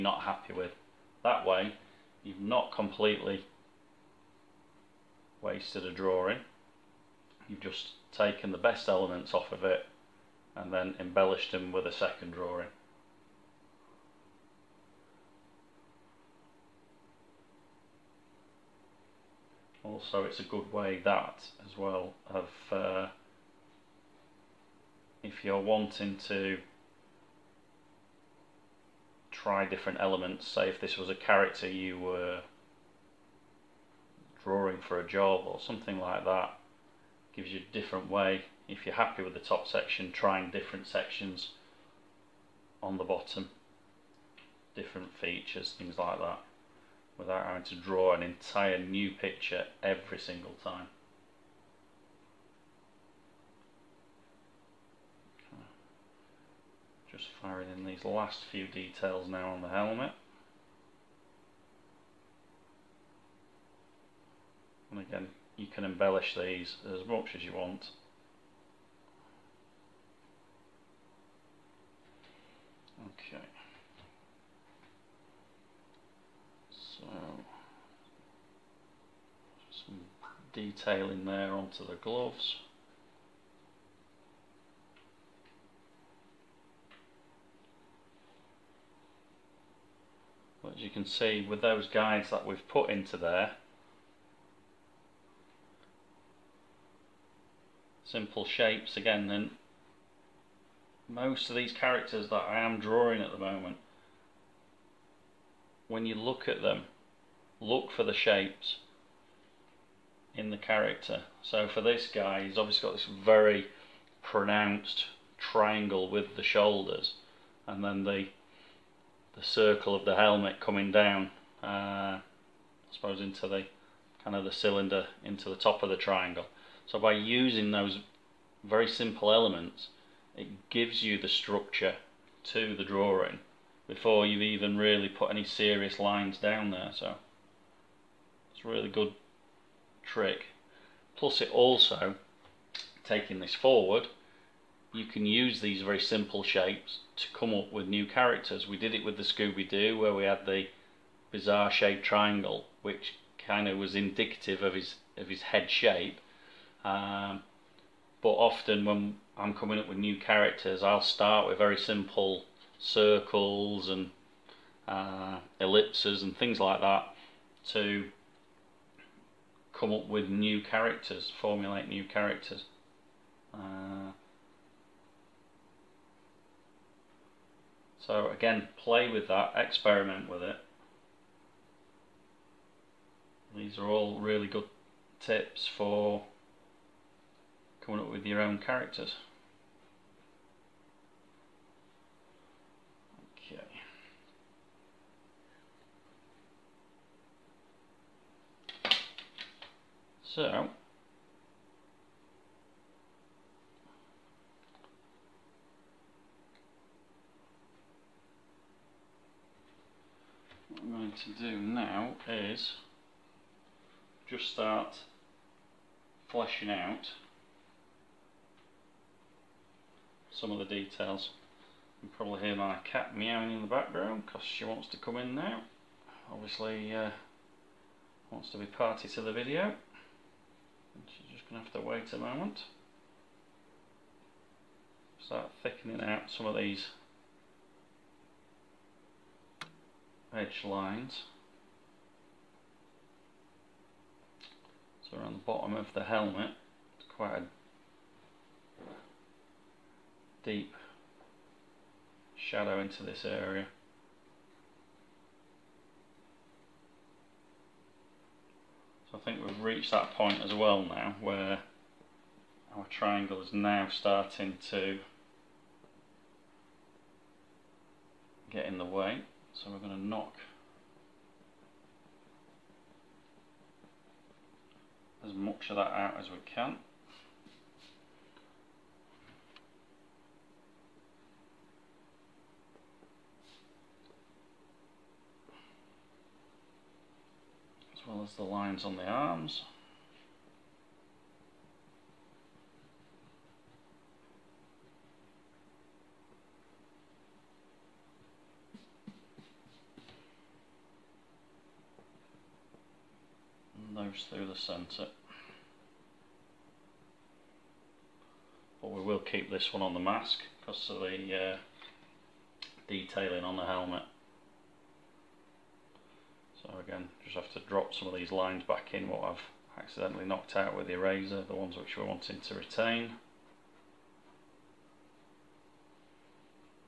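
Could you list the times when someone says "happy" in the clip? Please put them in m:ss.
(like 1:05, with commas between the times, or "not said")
0:00, 0:38.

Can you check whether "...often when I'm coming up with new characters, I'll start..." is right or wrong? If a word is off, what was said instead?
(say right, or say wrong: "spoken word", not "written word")
right.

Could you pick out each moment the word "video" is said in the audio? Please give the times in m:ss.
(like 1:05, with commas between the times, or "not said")
3:49.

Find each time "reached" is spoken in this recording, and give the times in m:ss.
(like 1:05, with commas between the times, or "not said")
4:19.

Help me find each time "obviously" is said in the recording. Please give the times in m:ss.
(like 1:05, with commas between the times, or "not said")
1:52, 3:46.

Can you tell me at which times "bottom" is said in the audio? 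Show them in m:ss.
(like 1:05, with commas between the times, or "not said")
0:43, 4:05.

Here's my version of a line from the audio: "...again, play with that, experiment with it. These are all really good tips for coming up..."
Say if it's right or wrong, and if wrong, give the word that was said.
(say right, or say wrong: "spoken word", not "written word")
right.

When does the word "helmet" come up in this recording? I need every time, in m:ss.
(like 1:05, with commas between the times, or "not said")
0:59, 2:00, 4:06, 5:13.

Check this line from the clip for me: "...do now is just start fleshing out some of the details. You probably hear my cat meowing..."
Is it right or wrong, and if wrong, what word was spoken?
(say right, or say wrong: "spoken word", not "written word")
right.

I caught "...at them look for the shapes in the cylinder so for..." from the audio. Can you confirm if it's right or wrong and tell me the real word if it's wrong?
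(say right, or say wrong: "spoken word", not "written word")
wrong: "character", not "cylinder".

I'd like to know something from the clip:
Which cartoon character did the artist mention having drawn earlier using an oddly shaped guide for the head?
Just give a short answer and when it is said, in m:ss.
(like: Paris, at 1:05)
Scooby-Doo, at 2:29.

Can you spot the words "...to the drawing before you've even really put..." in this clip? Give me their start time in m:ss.
2:12.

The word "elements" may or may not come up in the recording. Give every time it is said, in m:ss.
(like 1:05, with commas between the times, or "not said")
0:08, 0:30, 2:09.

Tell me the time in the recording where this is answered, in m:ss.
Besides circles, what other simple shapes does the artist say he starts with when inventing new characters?
2:45.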